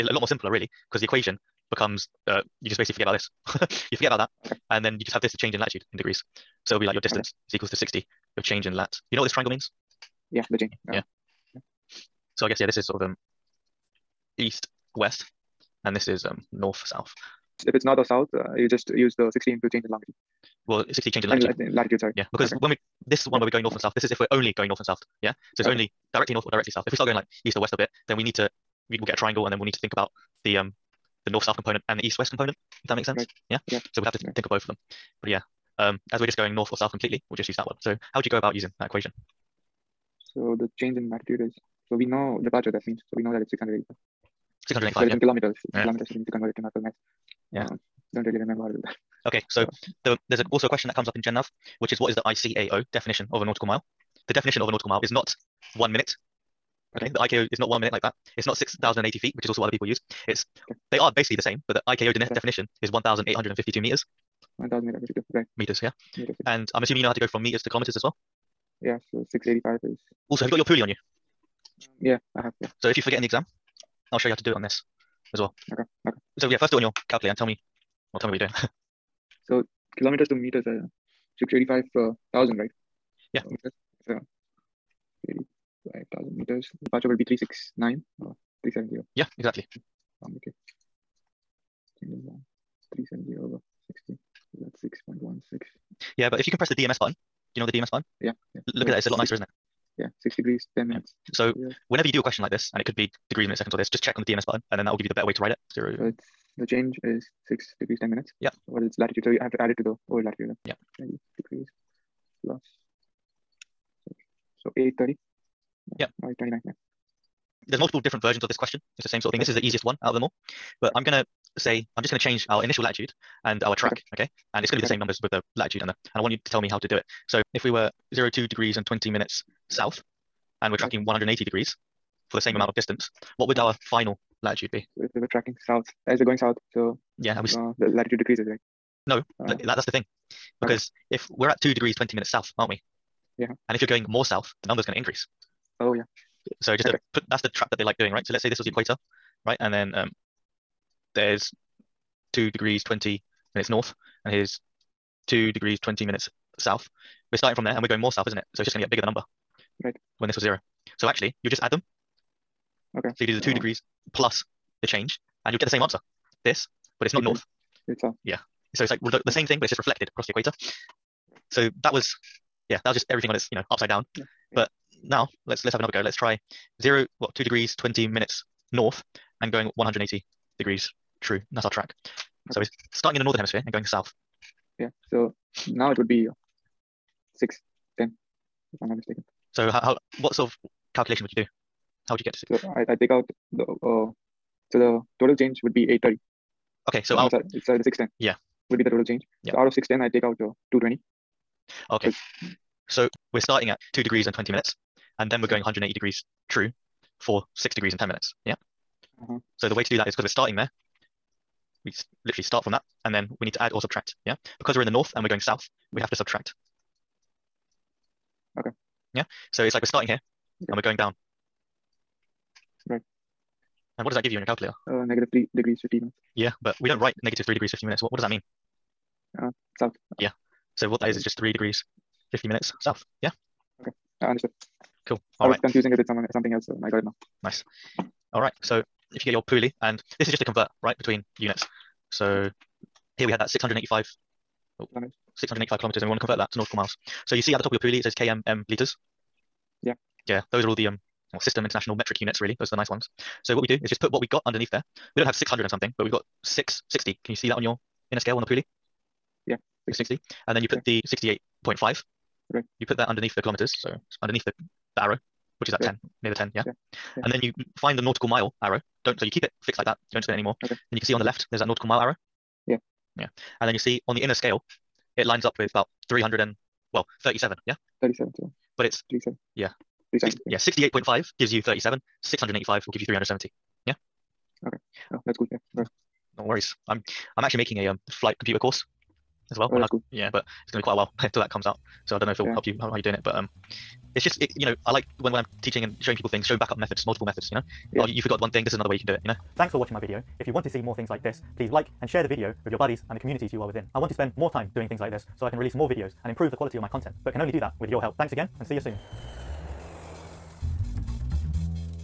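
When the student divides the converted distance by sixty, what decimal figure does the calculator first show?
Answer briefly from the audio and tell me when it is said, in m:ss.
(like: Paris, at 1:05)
6.16, at 1:35.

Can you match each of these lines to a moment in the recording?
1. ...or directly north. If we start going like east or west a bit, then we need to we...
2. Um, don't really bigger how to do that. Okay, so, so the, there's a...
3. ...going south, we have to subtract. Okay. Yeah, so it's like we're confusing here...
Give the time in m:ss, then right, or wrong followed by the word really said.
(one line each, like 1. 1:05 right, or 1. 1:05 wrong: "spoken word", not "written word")
1. 0:26 wrong: "south", not "north"
2. 0:47 wrong: "remember", not "bigger"
3. 3:35 wrong: "starting", not "confusing".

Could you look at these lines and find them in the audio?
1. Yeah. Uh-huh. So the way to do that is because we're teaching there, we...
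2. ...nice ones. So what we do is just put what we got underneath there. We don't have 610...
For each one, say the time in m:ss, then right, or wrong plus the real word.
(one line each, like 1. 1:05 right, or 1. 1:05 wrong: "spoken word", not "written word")
1. 3:28 wrong: "starting", not "teaching"
2. 4:12 wrong: "600", not "610".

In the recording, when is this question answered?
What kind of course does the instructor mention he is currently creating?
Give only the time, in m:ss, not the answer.
4:48.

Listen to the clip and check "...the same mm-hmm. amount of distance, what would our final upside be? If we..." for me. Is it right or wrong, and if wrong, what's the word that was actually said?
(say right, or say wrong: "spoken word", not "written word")
wrong: "latitude", not "upside".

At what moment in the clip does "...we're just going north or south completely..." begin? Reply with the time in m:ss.
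0:36.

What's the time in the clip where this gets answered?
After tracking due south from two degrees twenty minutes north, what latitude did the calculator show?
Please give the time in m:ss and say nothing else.
3:47.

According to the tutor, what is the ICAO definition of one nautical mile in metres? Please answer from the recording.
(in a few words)
1,852 meters.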